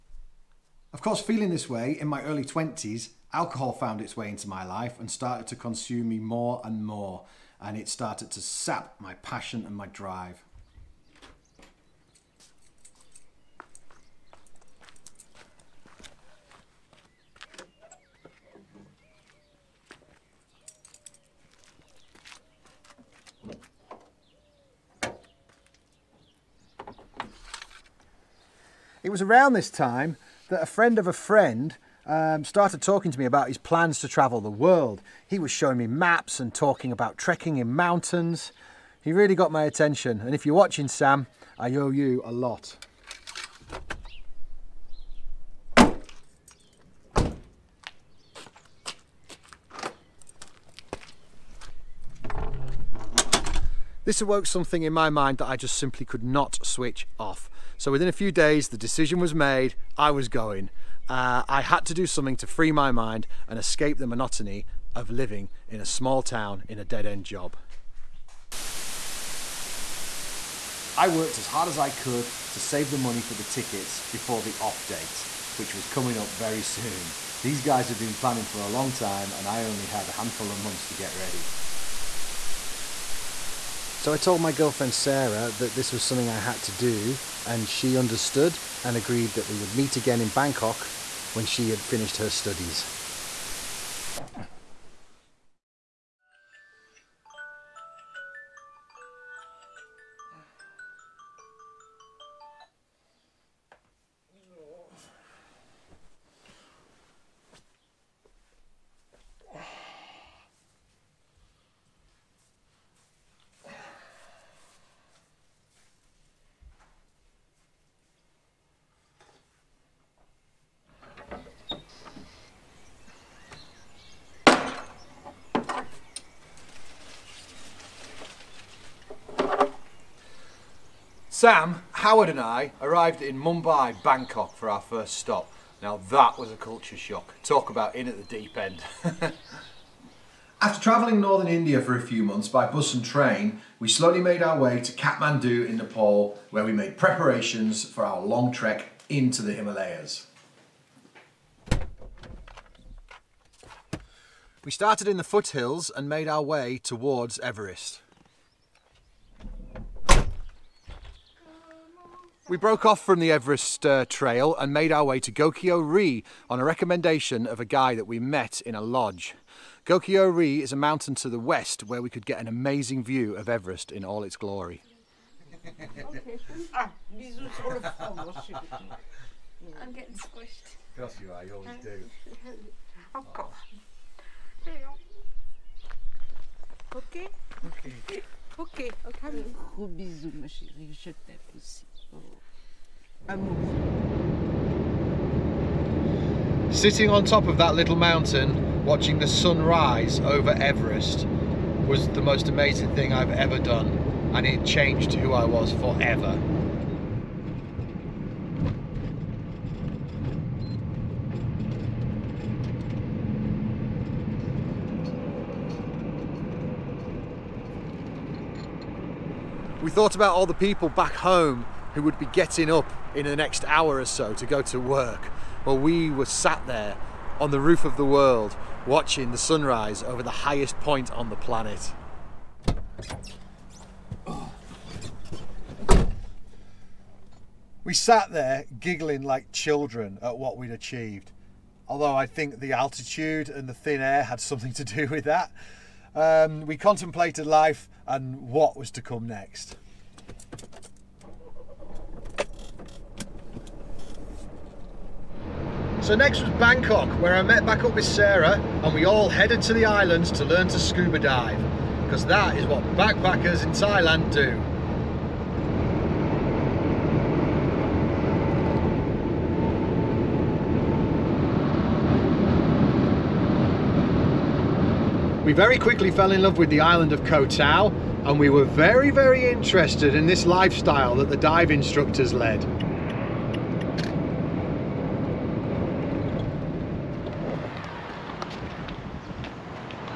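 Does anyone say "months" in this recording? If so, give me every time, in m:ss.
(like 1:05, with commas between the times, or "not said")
1:20, 2:22.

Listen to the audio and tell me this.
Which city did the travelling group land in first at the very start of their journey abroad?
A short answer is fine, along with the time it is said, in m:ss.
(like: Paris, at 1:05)
Mumbai, at 2:13.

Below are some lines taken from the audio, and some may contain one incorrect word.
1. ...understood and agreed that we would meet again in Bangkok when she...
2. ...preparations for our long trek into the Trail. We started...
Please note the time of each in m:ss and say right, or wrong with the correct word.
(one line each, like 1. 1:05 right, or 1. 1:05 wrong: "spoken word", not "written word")
1. 1:27 right
2. 2:26 wrong: "Himalayas", not "Trail".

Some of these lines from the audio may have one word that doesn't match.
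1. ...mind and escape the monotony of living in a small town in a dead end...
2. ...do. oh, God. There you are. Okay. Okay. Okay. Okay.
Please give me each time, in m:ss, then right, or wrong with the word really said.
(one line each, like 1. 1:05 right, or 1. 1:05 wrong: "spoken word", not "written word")
1. 1:02 right
2. 3:01 right.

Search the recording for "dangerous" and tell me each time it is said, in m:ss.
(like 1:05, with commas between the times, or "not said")
not said.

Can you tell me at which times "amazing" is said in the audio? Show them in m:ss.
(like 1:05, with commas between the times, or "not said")
2:52, 3:22.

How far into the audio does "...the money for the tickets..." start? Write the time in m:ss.
1:12.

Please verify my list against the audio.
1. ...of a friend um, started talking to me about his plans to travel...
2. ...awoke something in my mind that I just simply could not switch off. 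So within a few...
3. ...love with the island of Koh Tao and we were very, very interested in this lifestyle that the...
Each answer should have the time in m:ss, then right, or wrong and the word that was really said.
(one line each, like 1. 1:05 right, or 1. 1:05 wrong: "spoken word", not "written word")
1. 0:30 right
2. 0:54 right
3. 4:36 right.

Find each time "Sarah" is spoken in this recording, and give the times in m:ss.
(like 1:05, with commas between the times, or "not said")
1:24, 4:18.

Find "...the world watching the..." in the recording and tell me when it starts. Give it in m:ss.
3:47.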